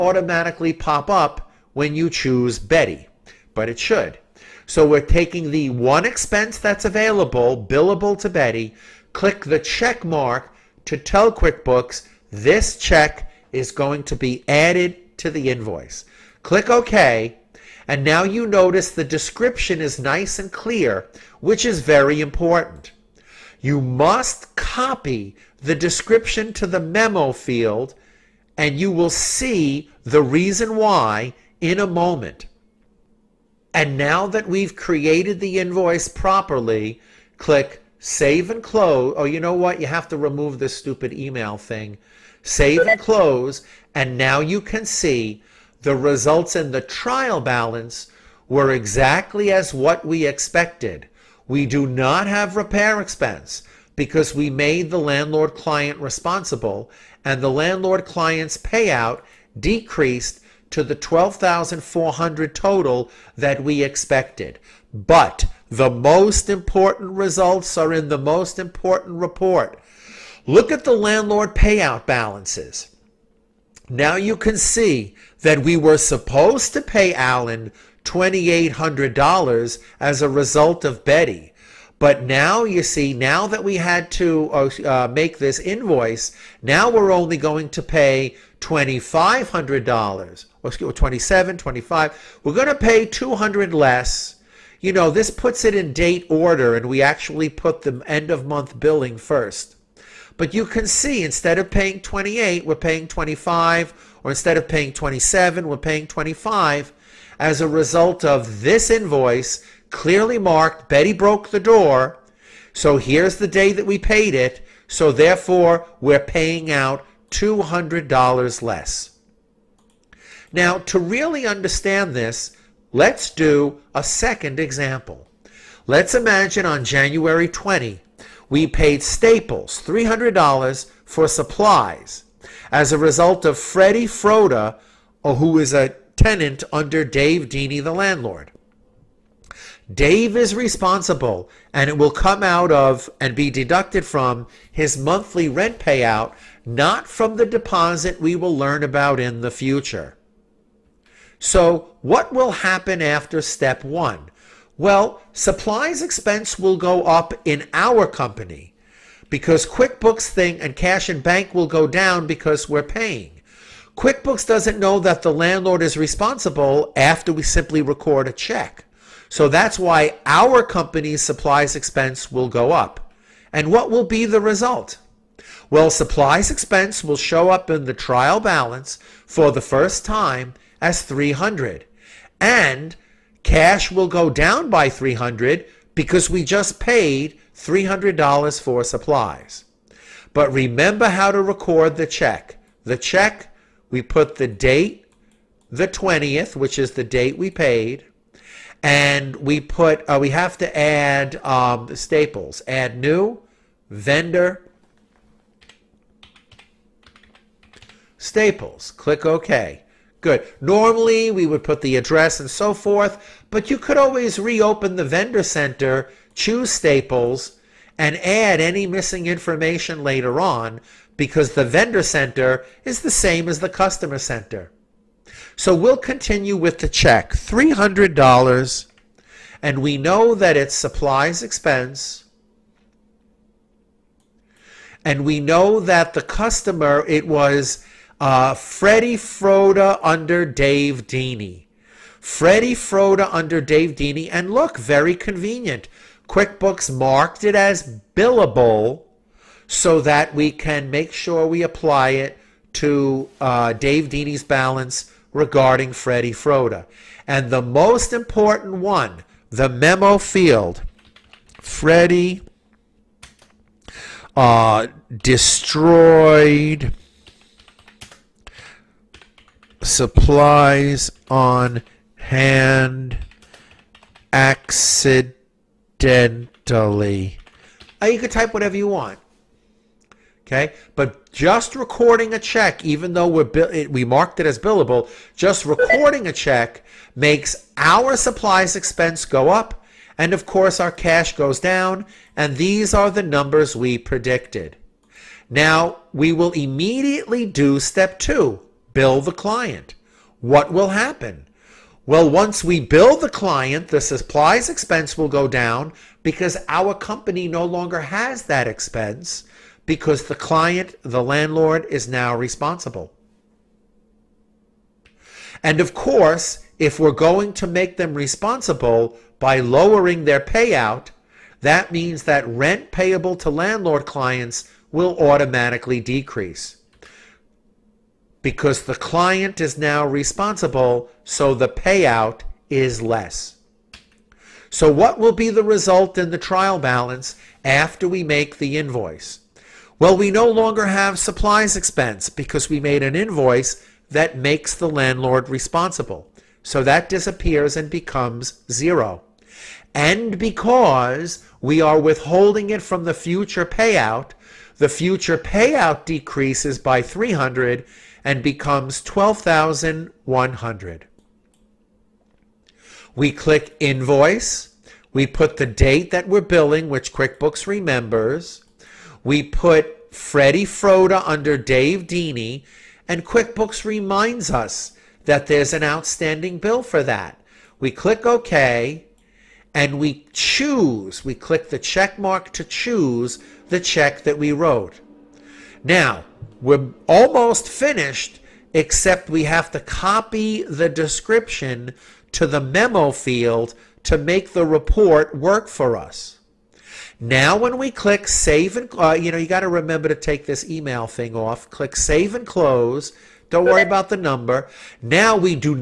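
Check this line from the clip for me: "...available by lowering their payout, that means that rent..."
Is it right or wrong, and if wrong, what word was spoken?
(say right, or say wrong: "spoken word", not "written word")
wrong: "responsible", not "available".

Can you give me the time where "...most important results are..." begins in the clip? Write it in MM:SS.
01:05.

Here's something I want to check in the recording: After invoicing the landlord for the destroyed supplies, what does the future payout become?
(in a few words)
12,100.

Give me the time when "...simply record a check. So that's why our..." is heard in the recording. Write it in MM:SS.
02:47.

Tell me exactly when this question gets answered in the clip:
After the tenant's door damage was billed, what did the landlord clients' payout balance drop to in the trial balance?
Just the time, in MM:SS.
01:00.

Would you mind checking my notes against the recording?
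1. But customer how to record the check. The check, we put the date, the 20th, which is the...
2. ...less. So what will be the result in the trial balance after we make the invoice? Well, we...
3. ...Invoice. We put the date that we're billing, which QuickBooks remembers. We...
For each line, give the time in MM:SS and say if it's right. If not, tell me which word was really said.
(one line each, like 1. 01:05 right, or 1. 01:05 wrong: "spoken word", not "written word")
1. 03:10 wrong: "remember", not "customer"
2. 05:33 right
3. 06:03 right.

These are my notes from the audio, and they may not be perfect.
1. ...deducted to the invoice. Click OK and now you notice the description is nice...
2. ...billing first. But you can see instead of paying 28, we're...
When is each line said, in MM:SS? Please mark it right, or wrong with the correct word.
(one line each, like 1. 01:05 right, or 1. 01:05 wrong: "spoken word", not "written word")
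1. 00:14 wrong: "added", not "deducted"
2. 01:38 right.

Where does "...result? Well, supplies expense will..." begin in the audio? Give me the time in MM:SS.
02:54.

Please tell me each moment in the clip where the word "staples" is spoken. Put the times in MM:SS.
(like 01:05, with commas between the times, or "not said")
02:09, 03:21, 03:28, 03:36.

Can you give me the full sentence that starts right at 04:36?
Now uh, you can type whatever you want.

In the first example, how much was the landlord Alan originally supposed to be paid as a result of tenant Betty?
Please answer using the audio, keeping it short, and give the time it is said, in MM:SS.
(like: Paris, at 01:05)
$2,800, at 01:18.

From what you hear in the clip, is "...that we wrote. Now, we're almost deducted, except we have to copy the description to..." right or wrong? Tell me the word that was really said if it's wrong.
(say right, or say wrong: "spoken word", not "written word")
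wrong: "finished", not "deducted".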